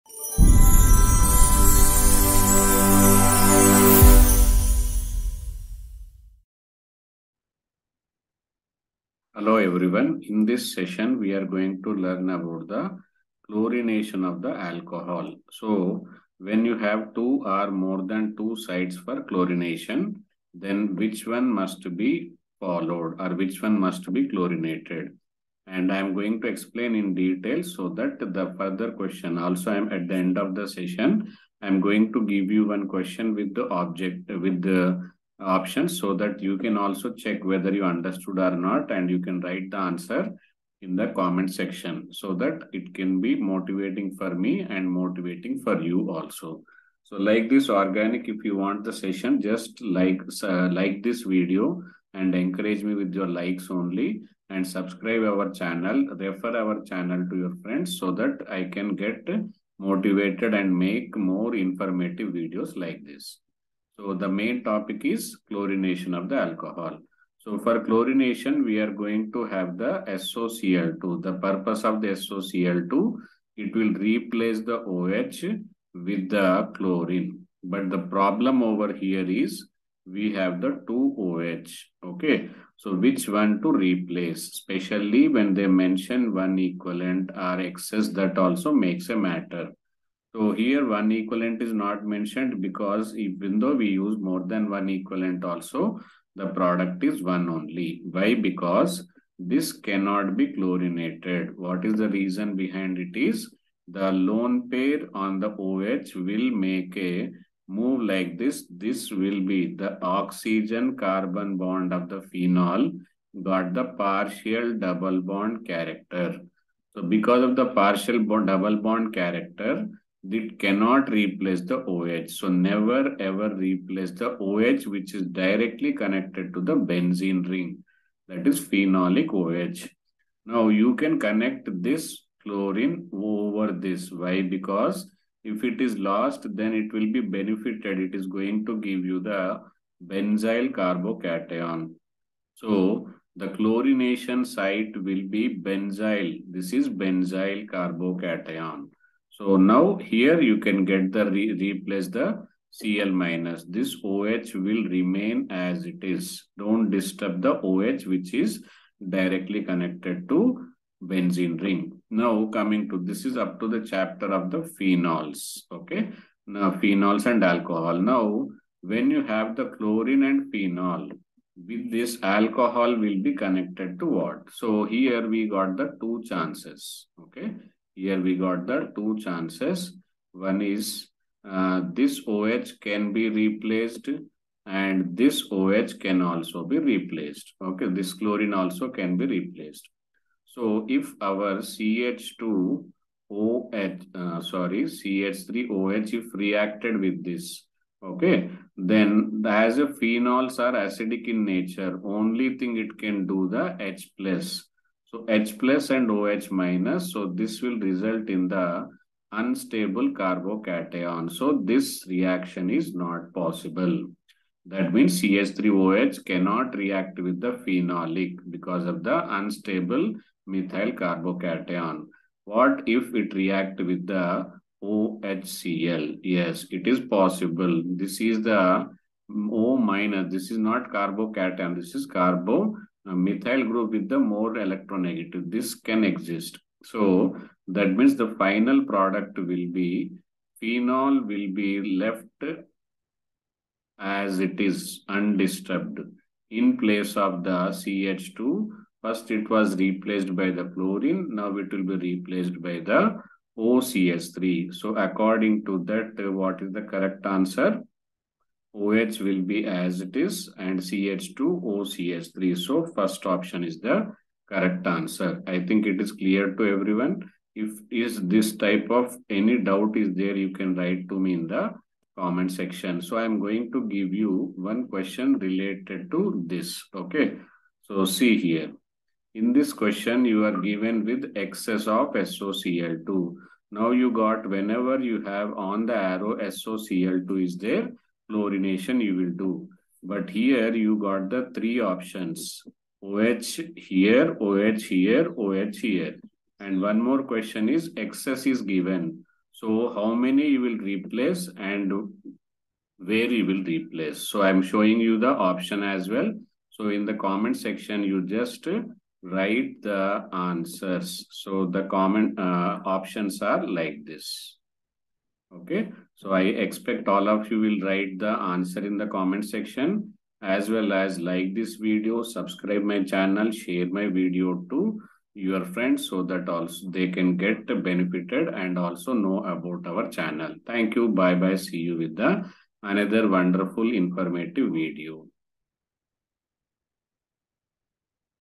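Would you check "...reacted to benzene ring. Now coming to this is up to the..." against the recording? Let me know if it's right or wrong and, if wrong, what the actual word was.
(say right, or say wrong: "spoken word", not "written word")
wrong: "connected", not "reacted".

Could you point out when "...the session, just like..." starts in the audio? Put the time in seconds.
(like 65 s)
48 s.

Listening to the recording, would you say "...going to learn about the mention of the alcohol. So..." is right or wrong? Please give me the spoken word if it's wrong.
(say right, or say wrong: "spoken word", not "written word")
wrong: "chlorination", not "mention".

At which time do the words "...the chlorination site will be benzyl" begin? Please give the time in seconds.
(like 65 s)
143 s.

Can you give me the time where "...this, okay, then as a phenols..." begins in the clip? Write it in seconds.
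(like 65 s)
197 s.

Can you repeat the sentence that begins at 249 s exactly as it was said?
First it was replaced by the chlorine.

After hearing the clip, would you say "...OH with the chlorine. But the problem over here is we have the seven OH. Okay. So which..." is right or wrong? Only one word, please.
wrong.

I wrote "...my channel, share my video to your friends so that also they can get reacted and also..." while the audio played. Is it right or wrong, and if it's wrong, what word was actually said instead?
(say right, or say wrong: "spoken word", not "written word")
wrong: "benefited", not "reacted".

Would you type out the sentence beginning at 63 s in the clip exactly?
So the main topic is chlorination of the alcohol.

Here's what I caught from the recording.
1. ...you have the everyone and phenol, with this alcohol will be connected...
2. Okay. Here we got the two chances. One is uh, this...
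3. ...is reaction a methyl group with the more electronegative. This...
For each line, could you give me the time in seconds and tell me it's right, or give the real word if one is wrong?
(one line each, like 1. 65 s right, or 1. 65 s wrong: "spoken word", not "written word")
1. 169 s wrong: "chlorine", not "everyone"
2. 177 s right
3. 231 s wrong: "carbocation", not "reaction".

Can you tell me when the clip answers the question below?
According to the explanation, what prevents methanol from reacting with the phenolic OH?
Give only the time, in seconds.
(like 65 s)
219 s.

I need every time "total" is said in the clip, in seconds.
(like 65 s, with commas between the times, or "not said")
not said.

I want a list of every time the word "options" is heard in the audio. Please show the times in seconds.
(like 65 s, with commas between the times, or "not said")
35 s, 263 s, 291 s, 305 s, 312 s.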